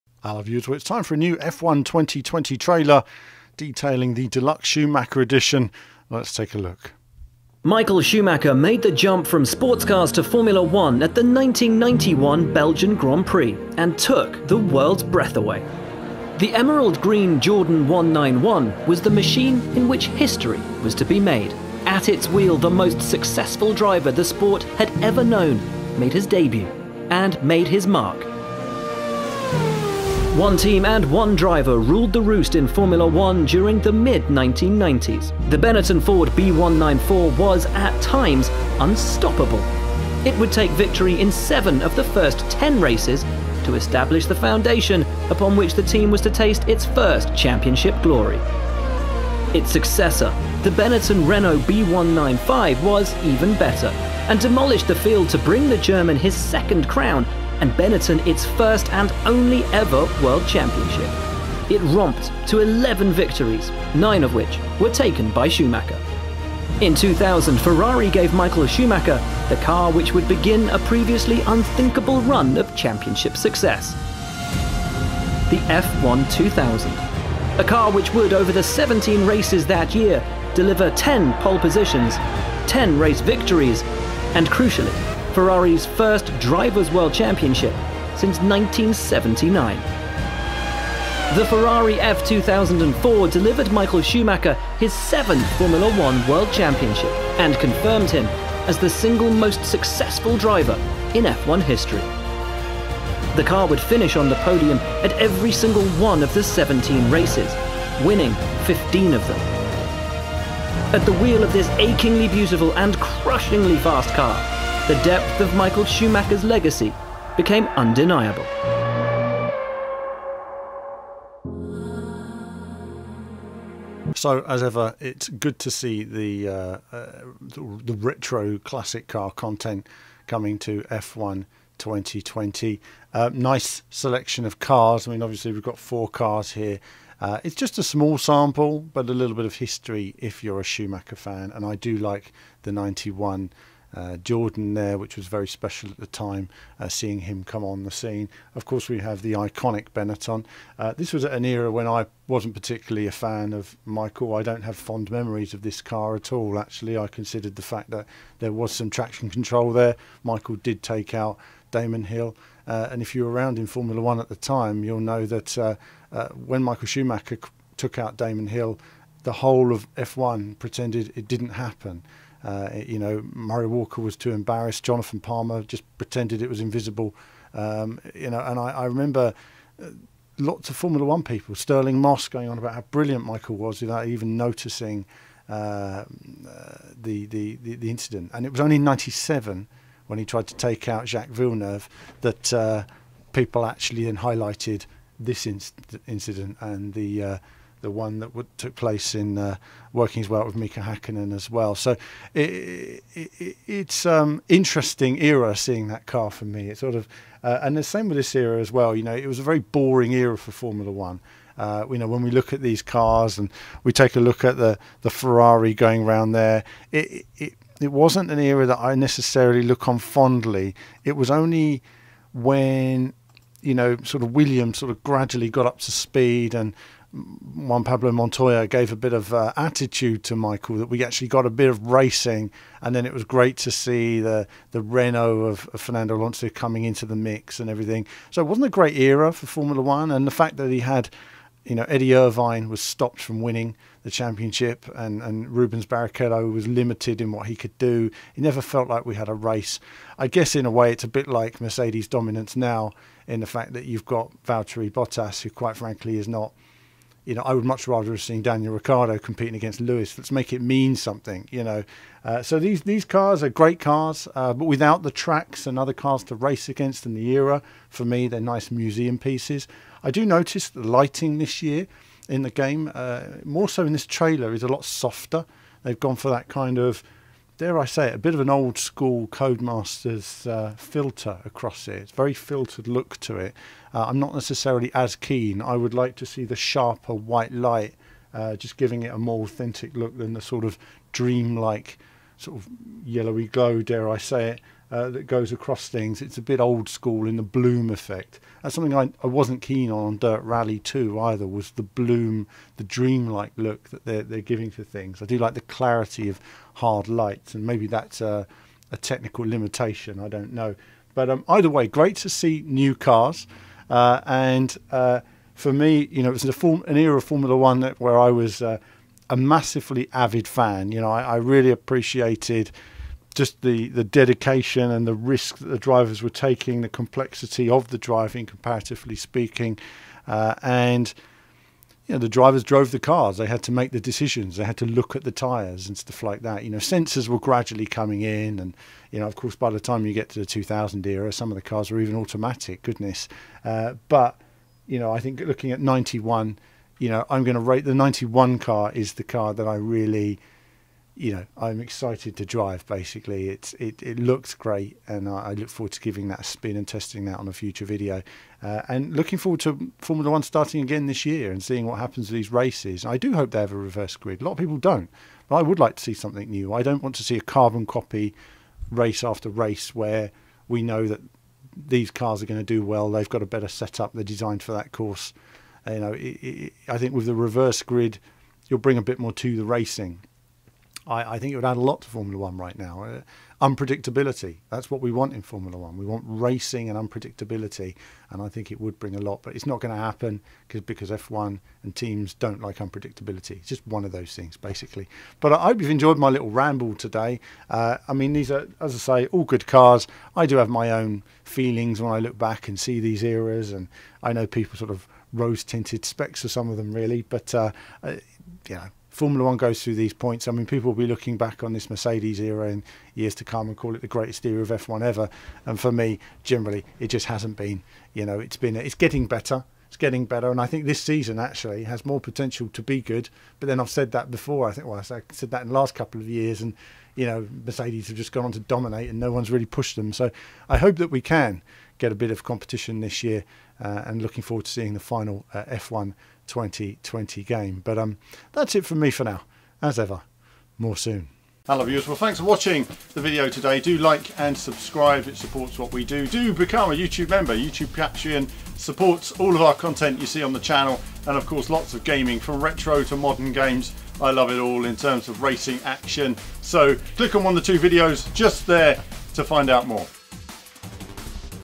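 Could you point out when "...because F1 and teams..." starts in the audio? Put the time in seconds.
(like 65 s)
390 s.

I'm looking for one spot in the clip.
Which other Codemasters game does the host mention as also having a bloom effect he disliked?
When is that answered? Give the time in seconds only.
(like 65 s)
300 s.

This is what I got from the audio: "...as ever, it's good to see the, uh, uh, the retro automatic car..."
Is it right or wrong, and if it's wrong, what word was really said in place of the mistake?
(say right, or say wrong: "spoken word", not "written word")
wrong: "classic", not "automatic".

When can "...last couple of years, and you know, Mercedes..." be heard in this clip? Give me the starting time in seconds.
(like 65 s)
425 s.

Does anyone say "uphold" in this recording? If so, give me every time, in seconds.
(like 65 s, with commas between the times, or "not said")
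not said.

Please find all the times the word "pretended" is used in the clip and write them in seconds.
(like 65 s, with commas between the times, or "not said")
170 s, 175 s.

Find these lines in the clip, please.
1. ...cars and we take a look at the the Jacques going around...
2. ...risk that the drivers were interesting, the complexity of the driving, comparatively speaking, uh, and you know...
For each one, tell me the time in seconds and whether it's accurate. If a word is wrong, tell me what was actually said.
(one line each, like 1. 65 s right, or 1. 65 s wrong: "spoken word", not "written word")
1. 212 s wrong: "Ferrari", not "Jacques"
2. 325 s wrong: "taking", not "interesting".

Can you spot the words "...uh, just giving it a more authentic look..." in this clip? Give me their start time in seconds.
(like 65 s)
288 s.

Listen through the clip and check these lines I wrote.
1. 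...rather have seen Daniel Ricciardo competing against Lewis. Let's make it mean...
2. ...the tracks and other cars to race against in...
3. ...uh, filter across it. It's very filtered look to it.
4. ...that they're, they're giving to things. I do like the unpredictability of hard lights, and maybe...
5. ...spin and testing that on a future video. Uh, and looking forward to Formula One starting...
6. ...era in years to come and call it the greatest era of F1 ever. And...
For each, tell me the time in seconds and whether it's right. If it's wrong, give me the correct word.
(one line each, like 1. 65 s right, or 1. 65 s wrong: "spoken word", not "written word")
1. 257 s right
2. 265 s right
3. 280 s right
4. 303 s wrong: "clarity", not "unpredictability"
5. 356 s right
6. 412 s right.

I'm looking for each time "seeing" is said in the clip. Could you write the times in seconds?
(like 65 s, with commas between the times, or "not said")
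146 s, 205 s, 361 s, 434 s.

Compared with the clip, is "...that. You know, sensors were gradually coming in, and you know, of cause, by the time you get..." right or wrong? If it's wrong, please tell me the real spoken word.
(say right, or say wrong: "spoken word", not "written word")
wrong: "course", not "cause".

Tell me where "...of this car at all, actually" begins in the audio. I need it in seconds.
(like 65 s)
155 s.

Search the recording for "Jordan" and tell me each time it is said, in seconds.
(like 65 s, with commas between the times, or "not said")
17 s, 144 s.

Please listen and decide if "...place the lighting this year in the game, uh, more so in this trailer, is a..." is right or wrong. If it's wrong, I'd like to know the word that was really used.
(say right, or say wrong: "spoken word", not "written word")
wrong: "notice", not "place".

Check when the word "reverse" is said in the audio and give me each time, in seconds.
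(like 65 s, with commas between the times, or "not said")
363 s, 377 s.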